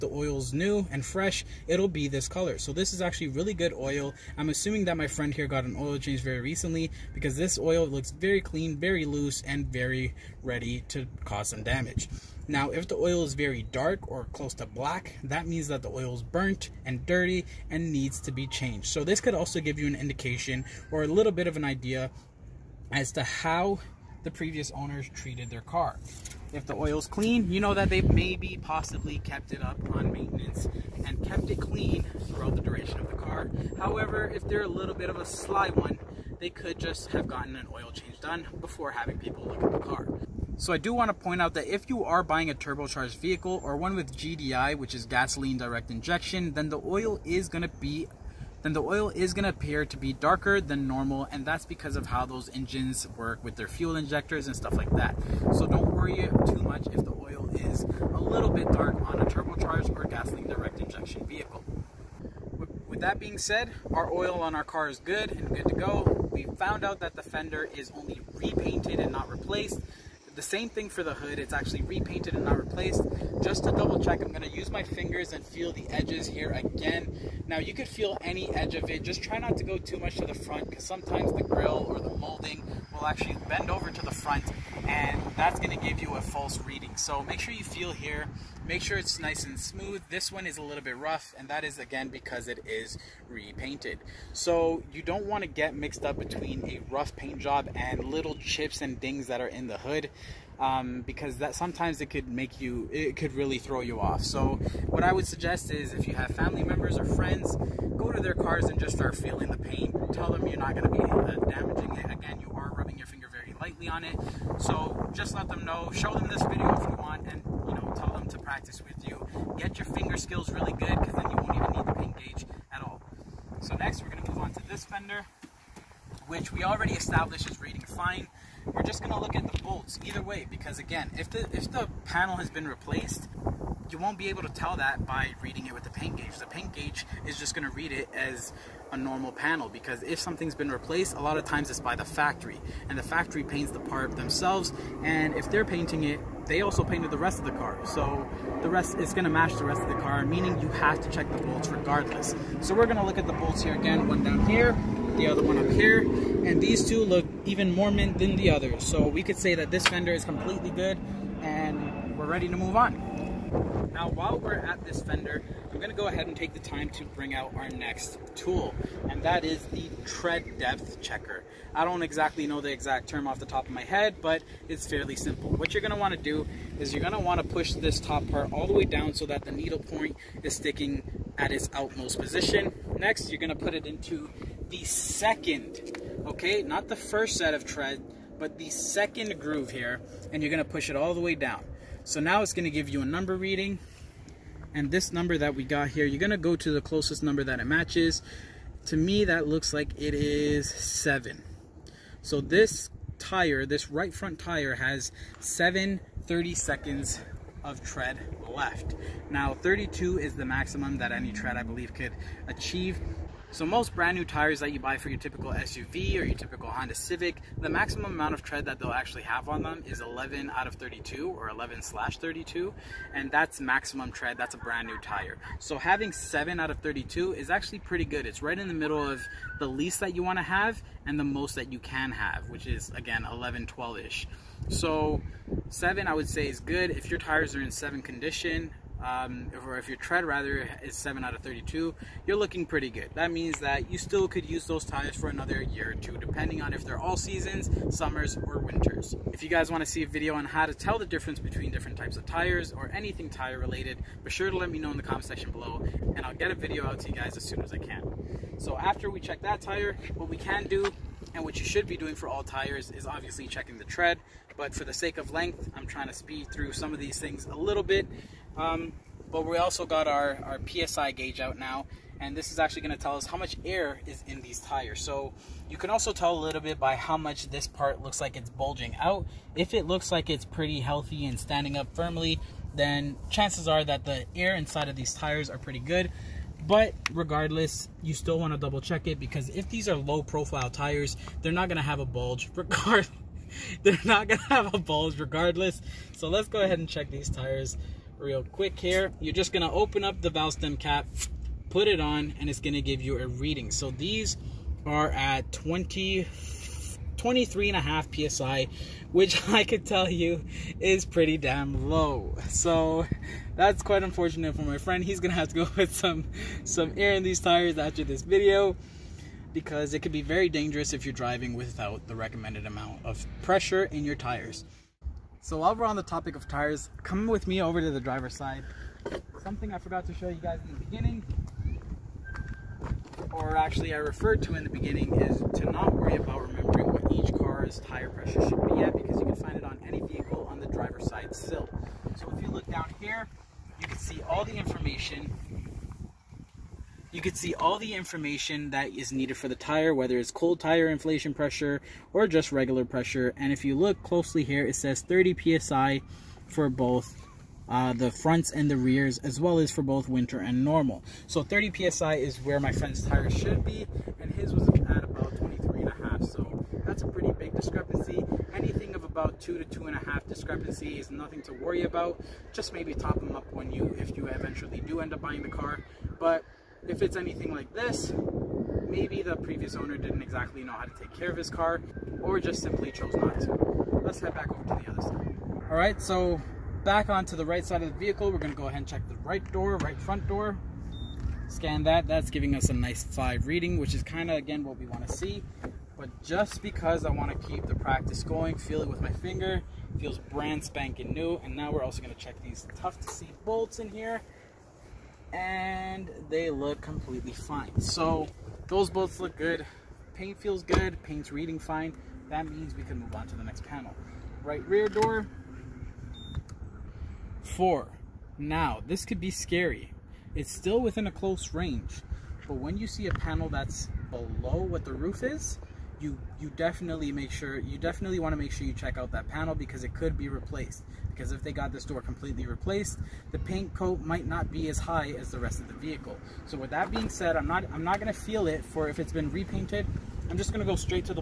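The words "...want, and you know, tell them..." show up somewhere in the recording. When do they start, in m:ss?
1:56.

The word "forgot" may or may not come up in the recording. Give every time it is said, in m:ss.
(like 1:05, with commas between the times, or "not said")
5:29.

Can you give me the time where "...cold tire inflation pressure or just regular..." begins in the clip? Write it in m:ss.
5:50.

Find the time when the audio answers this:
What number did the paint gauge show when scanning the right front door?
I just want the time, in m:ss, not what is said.
6:33.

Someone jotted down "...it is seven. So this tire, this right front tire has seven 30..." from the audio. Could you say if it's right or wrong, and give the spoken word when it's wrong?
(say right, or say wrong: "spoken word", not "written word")
right.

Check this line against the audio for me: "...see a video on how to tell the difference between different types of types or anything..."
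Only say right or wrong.
wrong.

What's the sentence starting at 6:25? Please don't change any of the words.
All right, so back onto the right side of the vehicle.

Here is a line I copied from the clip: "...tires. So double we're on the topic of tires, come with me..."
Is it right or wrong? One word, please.
wrong.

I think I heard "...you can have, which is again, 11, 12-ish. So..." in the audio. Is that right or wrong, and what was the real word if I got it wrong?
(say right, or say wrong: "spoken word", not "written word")
right.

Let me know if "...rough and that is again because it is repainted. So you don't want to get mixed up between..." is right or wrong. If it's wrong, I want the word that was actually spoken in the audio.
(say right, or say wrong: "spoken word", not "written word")
right.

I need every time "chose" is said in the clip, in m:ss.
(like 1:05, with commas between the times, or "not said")
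6:22.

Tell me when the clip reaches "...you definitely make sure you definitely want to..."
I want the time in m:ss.
7:06.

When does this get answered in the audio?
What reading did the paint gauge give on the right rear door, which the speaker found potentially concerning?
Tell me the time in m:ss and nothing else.
6:57.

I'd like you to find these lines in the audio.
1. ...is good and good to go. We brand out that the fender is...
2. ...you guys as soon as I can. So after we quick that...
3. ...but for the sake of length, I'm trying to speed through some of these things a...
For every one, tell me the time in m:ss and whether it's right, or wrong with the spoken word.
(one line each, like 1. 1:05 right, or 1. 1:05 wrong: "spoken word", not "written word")
1. 1:04 wrong: "found", not "brand"
2. 4:17 wrong: "check", not "quick"
3. 4:24 right.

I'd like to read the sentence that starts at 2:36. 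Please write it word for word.
And these two look even more mint than the others.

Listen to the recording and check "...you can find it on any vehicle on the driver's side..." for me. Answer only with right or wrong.
right.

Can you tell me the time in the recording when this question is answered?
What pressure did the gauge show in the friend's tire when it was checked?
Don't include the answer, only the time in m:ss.
5:07.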